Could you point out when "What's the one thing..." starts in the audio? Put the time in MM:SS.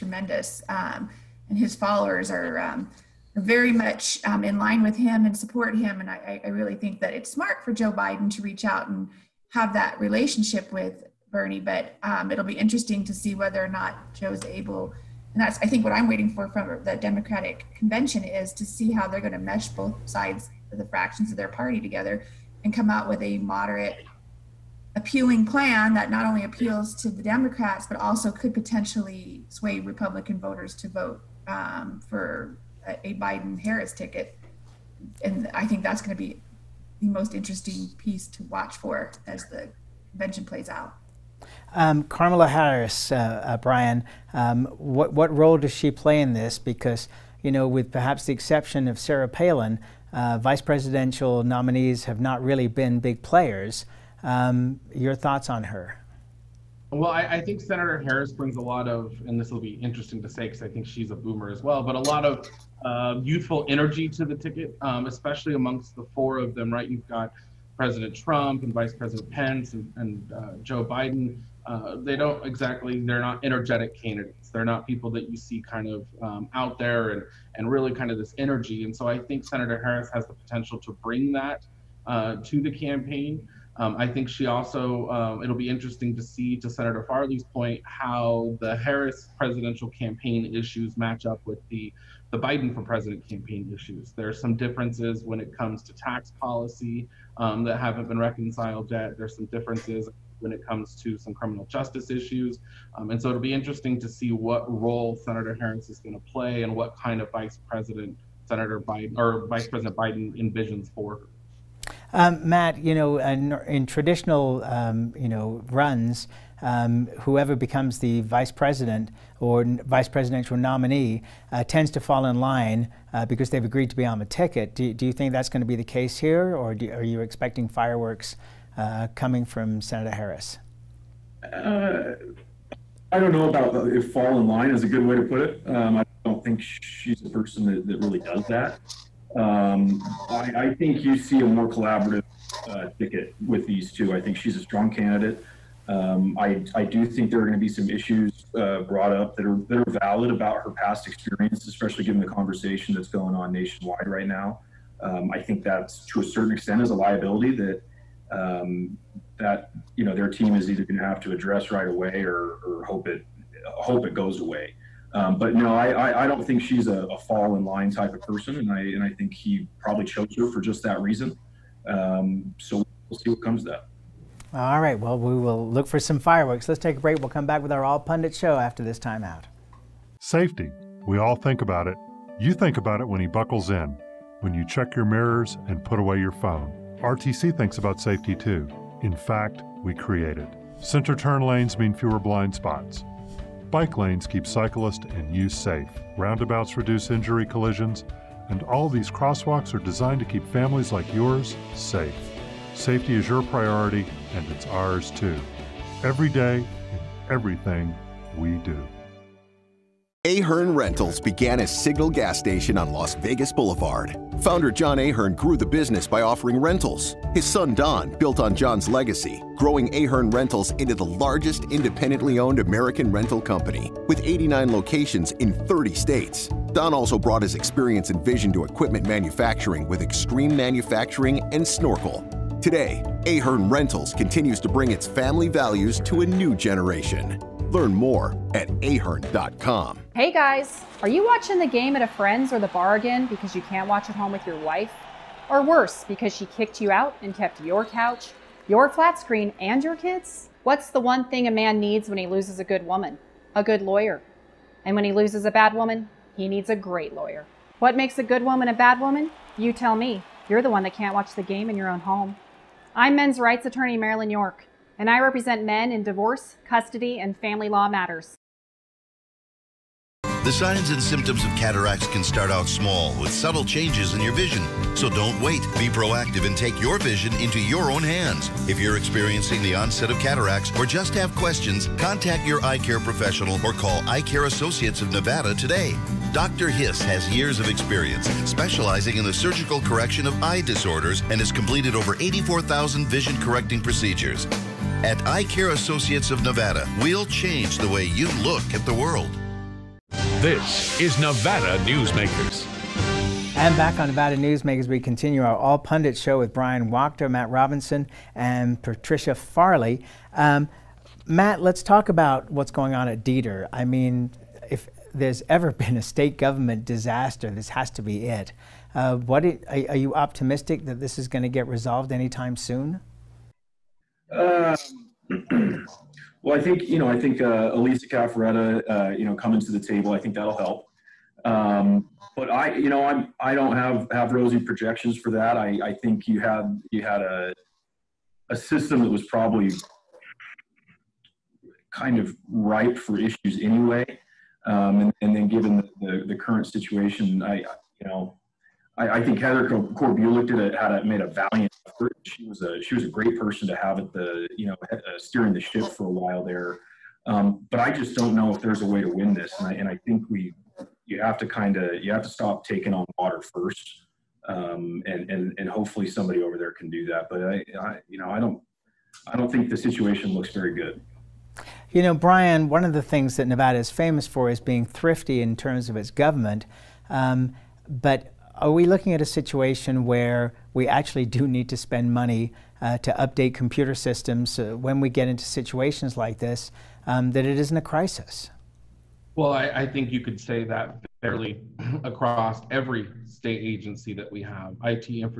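04:10.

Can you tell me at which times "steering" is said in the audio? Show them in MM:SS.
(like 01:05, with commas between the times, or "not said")
05:55.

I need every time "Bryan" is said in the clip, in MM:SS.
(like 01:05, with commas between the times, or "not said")
00:43, 05:06.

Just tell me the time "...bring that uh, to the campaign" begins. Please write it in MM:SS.
01:21.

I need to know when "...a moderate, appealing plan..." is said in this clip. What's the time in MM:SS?
00:23.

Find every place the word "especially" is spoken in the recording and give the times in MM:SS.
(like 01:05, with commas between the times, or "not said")
01:05, 02:31.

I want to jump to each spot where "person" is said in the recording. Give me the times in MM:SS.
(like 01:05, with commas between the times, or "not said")
02:17, 02:48, 05:53.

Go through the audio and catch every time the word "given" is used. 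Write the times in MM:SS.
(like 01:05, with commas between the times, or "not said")
02:32, 05:45.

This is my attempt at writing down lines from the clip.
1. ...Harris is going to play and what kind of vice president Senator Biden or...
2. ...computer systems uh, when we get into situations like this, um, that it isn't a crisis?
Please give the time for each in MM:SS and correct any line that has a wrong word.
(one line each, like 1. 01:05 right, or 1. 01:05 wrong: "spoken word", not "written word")
1. 01:45 right
2. 06:23 right.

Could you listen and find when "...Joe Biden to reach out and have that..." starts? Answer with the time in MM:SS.
00:07.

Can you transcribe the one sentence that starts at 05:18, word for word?
Uh, what it, are, are, you optimistic that this is going to get resolved anytime soon?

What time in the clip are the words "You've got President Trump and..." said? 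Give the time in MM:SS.
01:06.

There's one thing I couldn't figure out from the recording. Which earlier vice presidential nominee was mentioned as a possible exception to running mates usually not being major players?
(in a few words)
Sarah Palin.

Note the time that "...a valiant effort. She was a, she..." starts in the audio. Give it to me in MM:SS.
05:51.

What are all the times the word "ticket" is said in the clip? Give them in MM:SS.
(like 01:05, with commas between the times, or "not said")
00:33, 01:04, 02:04, 02:22.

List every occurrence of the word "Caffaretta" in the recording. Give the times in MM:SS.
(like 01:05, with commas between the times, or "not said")
05:28.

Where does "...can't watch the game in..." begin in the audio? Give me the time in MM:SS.
04:20.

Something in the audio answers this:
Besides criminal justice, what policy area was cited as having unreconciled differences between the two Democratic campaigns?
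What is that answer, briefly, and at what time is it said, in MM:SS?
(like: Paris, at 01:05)
Tax policy, at 01:35.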